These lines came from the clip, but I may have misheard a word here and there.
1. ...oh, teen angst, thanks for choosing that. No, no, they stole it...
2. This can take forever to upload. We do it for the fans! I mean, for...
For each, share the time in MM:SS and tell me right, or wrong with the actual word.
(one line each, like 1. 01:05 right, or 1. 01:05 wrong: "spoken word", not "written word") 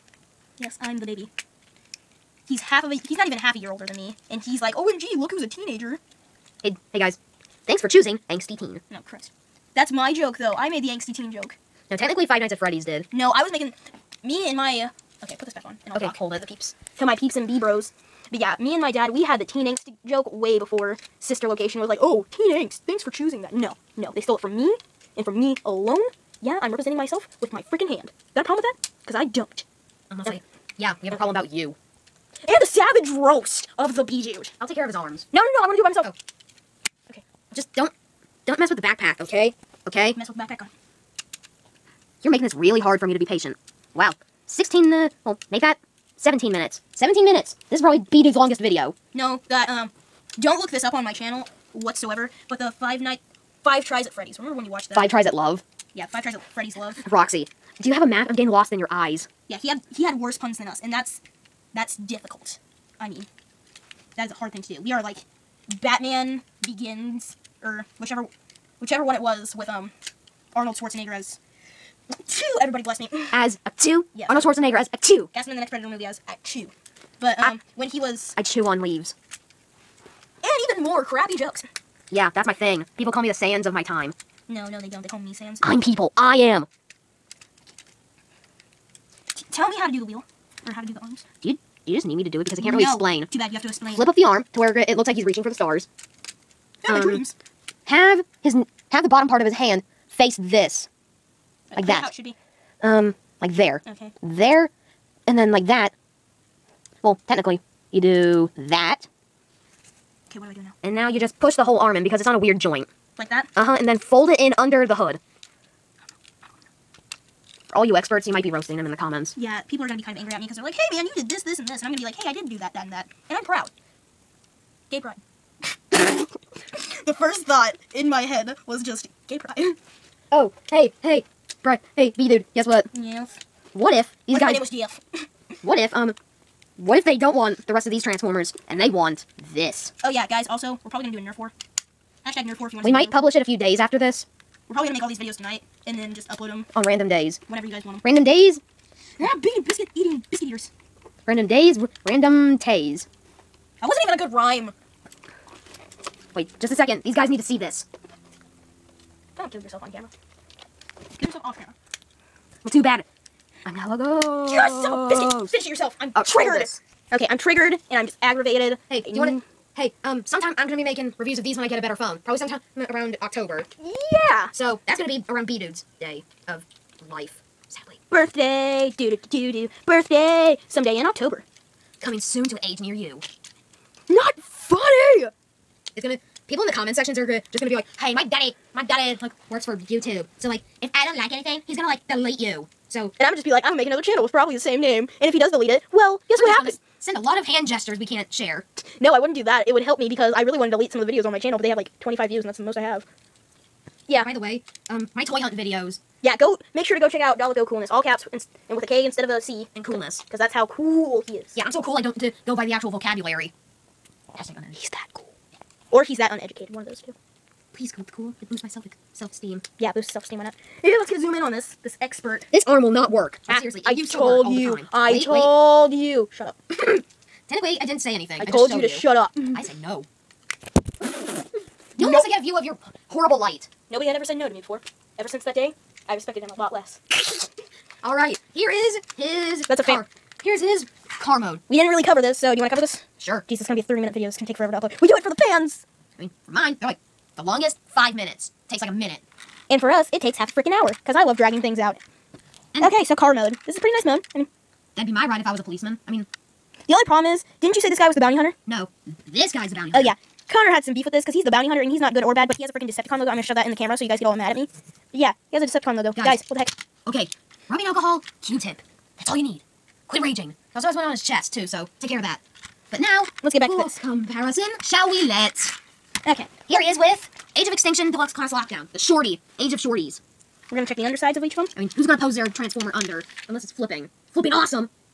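1. 00:21 right
2. 04:04 right.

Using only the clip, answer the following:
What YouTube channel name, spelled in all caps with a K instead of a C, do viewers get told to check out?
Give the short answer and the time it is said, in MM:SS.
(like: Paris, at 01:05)
DALEKKOOLNESS, at 03:27.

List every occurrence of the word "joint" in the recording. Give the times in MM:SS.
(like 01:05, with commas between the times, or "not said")
01:52.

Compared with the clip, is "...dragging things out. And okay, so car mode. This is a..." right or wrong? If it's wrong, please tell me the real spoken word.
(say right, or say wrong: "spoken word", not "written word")
right.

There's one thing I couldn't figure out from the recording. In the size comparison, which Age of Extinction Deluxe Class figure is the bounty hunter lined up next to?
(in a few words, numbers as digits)
Lockdown.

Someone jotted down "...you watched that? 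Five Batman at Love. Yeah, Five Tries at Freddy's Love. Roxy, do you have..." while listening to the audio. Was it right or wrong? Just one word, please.
wrong.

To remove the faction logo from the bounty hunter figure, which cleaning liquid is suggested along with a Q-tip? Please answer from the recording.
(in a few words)
rubbing alcohol.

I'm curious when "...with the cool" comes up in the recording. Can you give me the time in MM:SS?
03:37.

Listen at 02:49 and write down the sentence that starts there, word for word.
Hey, um, sometime I'm gonna be making reviews of these when I get a better phone.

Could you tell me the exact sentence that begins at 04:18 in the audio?
No, this guy's the bounty oh, hunter.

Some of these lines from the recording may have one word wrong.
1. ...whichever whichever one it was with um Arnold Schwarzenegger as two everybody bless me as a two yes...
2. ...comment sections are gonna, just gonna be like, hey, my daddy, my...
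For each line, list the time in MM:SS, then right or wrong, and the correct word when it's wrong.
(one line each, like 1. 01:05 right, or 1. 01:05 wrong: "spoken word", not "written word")
1. 01:07 right
2. 03:06 right.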